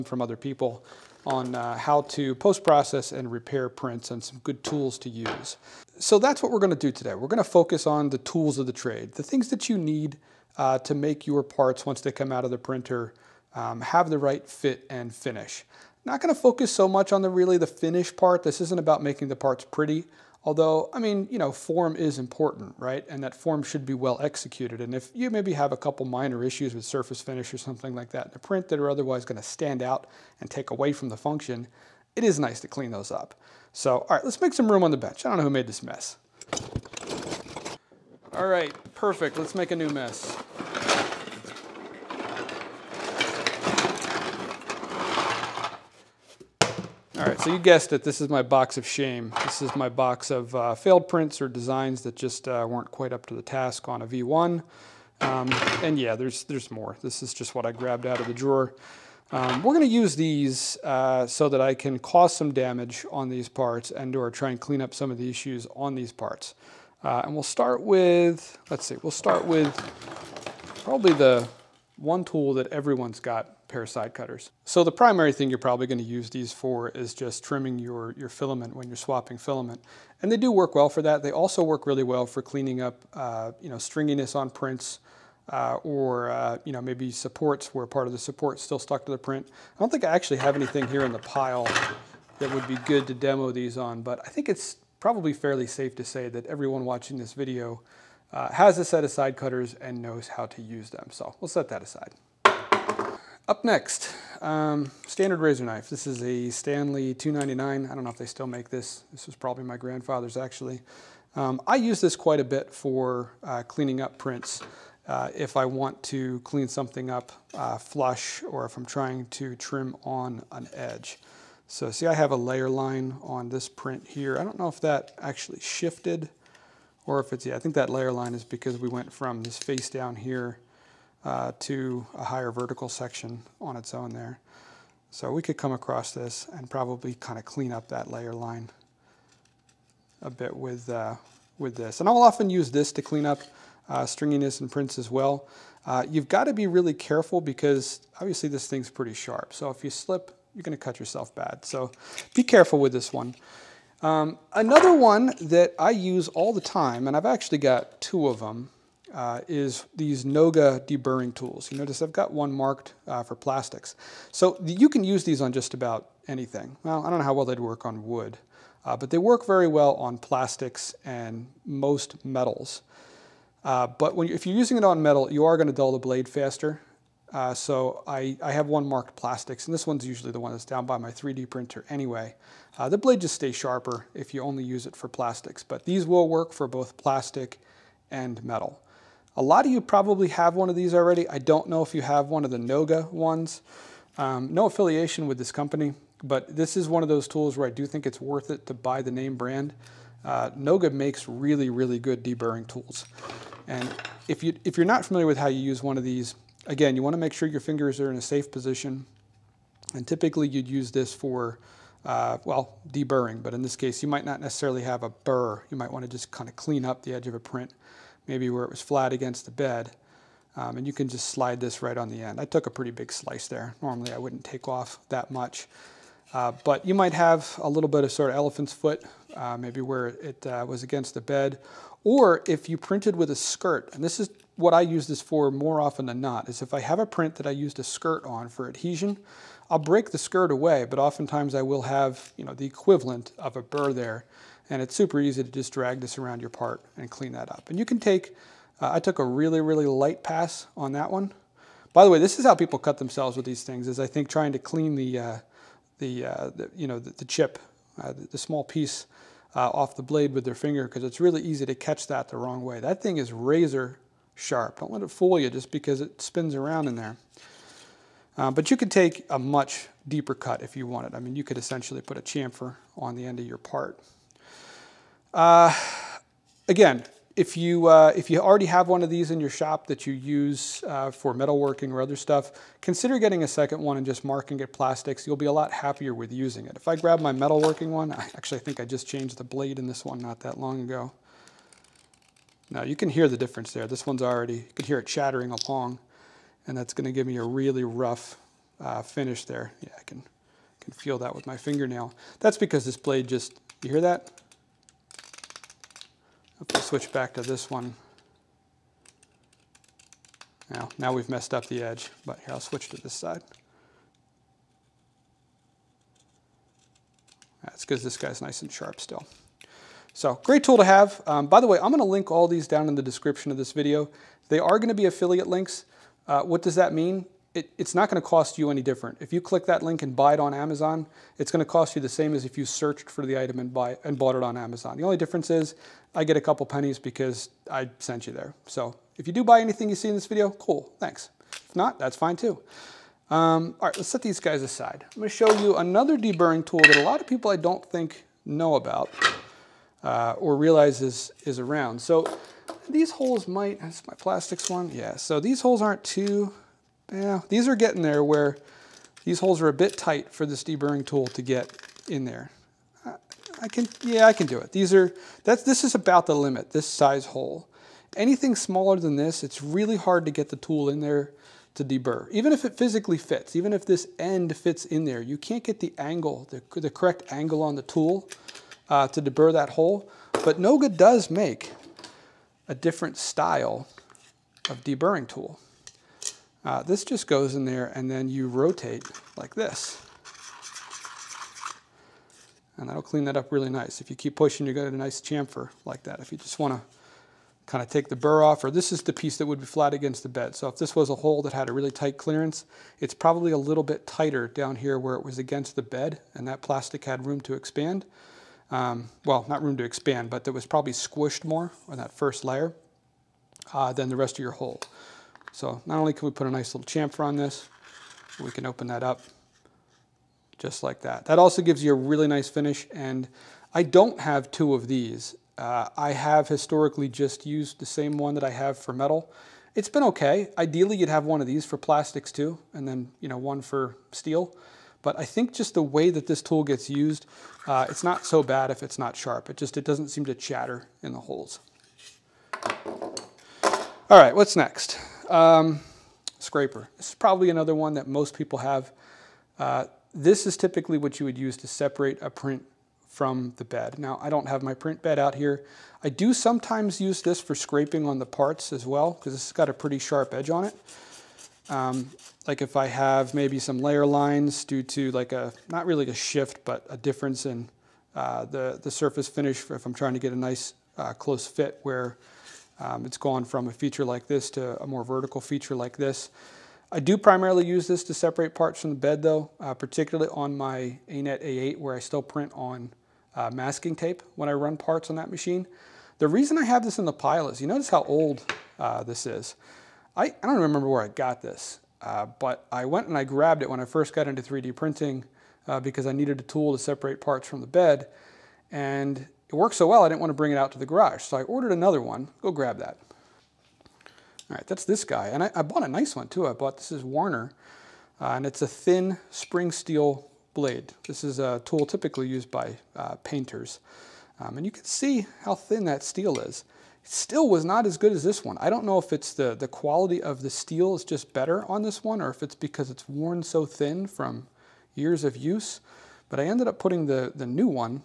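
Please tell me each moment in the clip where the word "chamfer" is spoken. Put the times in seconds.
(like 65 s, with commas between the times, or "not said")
272 s, 395 s, 416 s.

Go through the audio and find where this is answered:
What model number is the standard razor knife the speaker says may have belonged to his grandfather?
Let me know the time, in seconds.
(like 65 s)
106 s.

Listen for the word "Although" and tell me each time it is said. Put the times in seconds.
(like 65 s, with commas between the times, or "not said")
20 s.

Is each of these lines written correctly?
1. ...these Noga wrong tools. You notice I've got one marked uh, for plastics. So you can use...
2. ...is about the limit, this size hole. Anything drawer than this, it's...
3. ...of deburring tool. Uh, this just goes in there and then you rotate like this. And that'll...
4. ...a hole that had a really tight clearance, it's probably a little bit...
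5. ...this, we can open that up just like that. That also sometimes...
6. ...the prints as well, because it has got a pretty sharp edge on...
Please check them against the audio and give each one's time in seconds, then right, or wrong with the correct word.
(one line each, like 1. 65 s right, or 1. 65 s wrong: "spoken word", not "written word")
1. 159 s wrong: "deburring", not "wrong"
2. 365 s wrong: "smaller", not "drawer"
3. 384 s right
4. 401 s right
5. 417 s wrong: "gives", not "sometimes"
6. 458 s wrong: "parts", not "prints".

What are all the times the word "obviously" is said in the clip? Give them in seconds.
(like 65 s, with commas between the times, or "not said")
148 s.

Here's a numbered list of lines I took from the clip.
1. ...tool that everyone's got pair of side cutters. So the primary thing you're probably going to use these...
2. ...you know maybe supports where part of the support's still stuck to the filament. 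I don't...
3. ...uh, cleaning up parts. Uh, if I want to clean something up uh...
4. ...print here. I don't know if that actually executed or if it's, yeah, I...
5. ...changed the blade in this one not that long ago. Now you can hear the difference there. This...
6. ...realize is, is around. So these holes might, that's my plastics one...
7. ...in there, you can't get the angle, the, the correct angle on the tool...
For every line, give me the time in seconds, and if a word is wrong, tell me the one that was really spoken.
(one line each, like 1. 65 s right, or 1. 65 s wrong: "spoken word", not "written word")
1. 72 s right
2. 86 s wrong: "print", not "filament"
3. 113 s wrong: "prints", not "parts"
4. 123 s wrong: "shifted", not "executed"
5. 289 s right
6. 350 s right
7. 374 s right.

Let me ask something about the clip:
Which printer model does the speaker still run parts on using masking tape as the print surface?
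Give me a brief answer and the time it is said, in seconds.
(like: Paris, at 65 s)
Anet A8, at 481 s.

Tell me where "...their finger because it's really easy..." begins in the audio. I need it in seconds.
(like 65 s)
260 s.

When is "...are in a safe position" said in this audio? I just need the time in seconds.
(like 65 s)
208 s.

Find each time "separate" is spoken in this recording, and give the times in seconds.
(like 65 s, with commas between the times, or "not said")
451 s, 478 s, 496 s.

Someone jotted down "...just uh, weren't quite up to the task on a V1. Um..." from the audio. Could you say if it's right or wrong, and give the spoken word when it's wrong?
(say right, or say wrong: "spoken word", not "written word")
right.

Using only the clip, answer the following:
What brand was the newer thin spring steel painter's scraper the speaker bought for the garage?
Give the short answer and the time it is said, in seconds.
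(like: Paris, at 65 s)
Warner, at 507 s.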